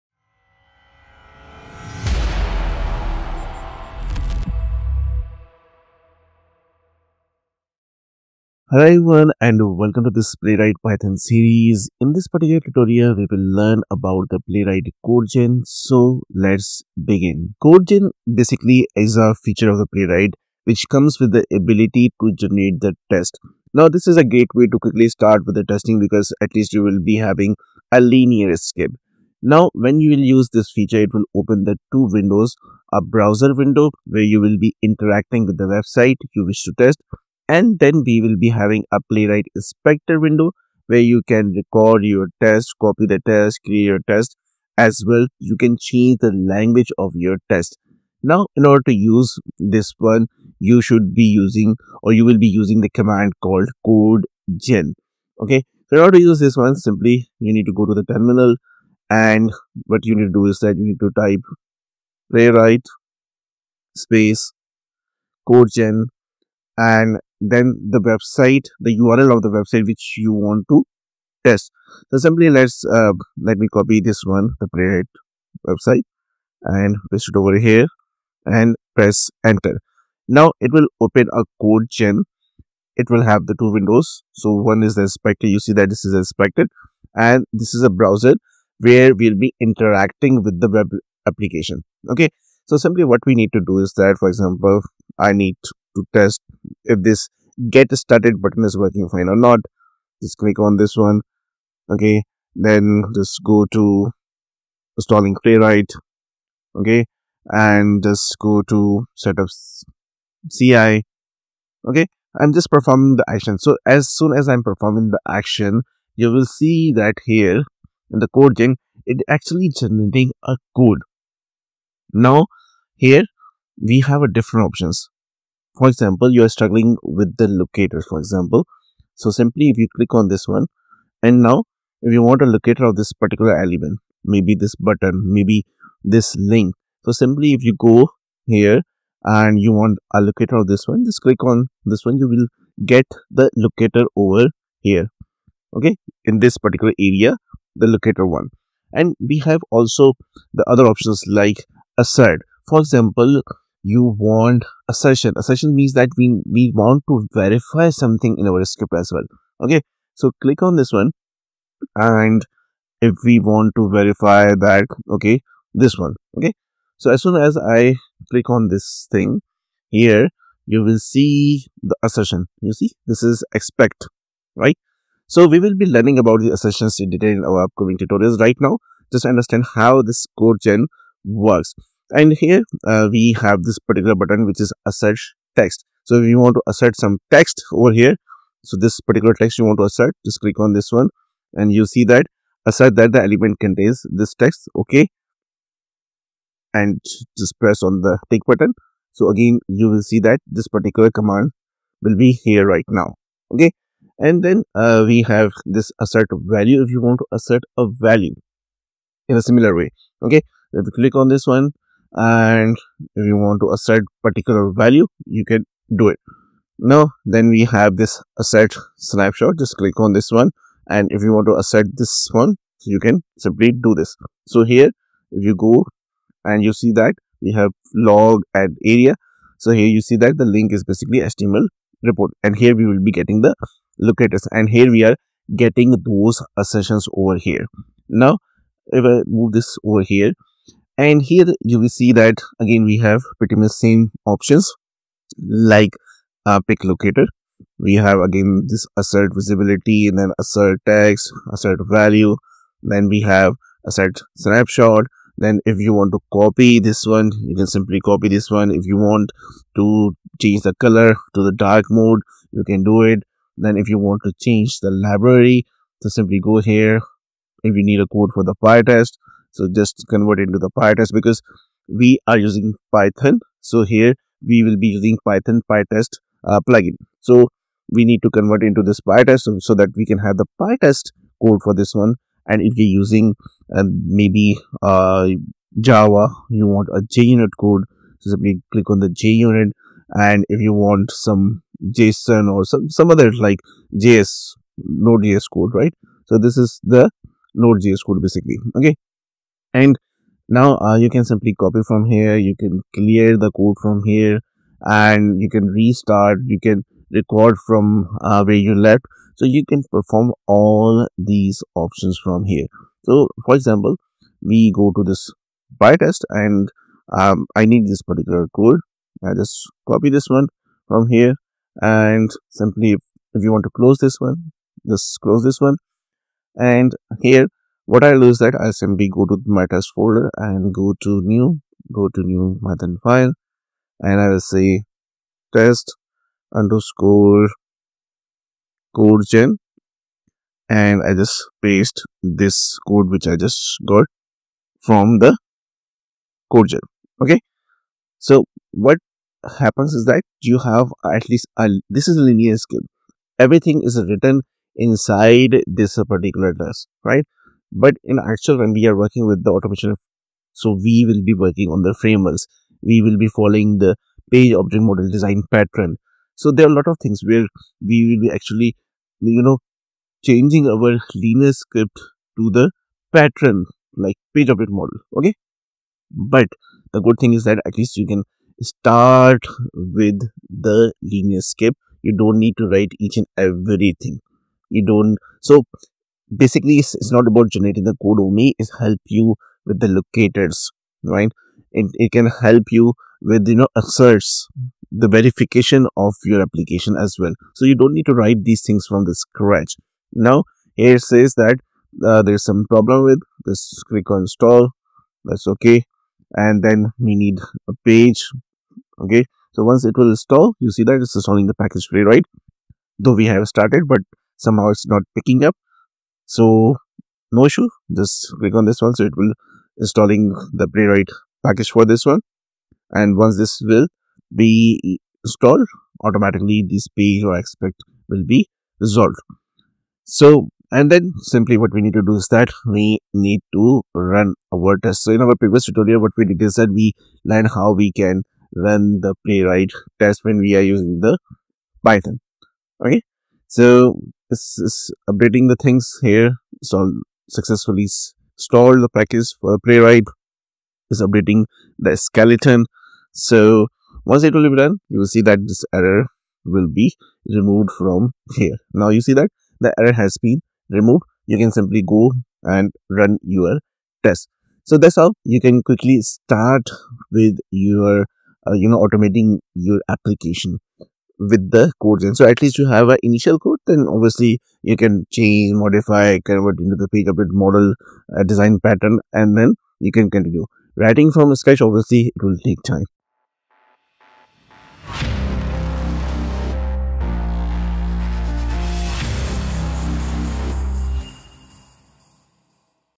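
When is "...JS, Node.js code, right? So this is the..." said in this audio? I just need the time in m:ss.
4:54.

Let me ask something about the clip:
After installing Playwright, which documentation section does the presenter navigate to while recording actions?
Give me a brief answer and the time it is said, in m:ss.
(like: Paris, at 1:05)
setup CI, at 1:49.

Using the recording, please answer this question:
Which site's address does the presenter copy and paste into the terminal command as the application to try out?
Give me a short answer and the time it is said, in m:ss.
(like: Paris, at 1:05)
Playwright website, at 1:14.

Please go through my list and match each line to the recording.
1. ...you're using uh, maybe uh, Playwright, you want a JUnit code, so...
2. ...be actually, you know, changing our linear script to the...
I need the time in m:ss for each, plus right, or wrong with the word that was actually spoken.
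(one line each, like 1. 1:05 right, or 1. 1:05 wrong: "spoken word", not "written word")
1. 4:42 wrong: "Java", not "Playwright"
2. 6:08 right.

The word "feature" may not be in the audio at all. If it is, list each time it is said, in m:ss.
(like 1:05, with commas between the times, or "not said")
0:19, 0:30.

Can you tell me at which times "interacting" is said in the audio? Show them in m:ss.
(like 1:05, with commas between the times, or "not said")
0:34, 1:29.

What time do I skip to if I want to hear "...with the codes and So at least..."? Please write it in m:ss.
7:51.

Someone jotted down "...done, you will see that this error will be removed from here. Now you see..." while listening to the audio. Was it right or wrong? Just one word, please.
right.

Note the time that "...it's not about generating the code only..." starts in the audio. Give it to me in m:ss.
6:26.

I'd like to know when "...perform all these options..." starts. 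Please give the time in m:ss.
5:09.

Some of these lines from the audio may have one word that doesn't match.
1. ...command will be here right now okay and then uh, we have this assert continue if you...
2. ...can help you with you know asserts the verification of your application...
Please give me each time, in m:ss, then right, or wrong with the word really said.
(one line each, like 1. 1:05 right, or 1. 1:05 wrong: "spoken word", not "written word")
1. 3:21 wrong: "value", not "continue"
2. 6:32 right.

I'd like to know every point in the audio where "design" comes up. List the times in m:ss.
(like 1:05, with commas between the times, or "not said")
6:05, 7:58.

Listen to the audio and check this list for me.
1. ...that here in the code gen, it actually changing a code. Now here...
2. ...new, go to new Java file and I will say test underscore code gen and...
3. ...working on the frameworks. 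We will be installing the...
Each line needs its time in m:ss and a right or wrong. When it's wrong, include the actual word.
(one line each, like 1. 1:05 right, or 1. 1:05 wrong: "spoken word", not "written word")
1. 1:56 wrong: "generating", not "changing"
2. 5:31 wrong: "Python", not "Java"
3. 6:01 wrong: "following", not "installing".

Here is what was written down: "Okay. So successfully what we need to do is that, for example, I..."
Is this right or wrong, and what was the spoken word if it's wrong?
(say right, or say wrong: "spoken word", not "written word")
wrong: "simply", not "successfully".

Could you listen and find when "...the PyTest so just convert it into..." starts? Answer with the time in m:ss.
4:28.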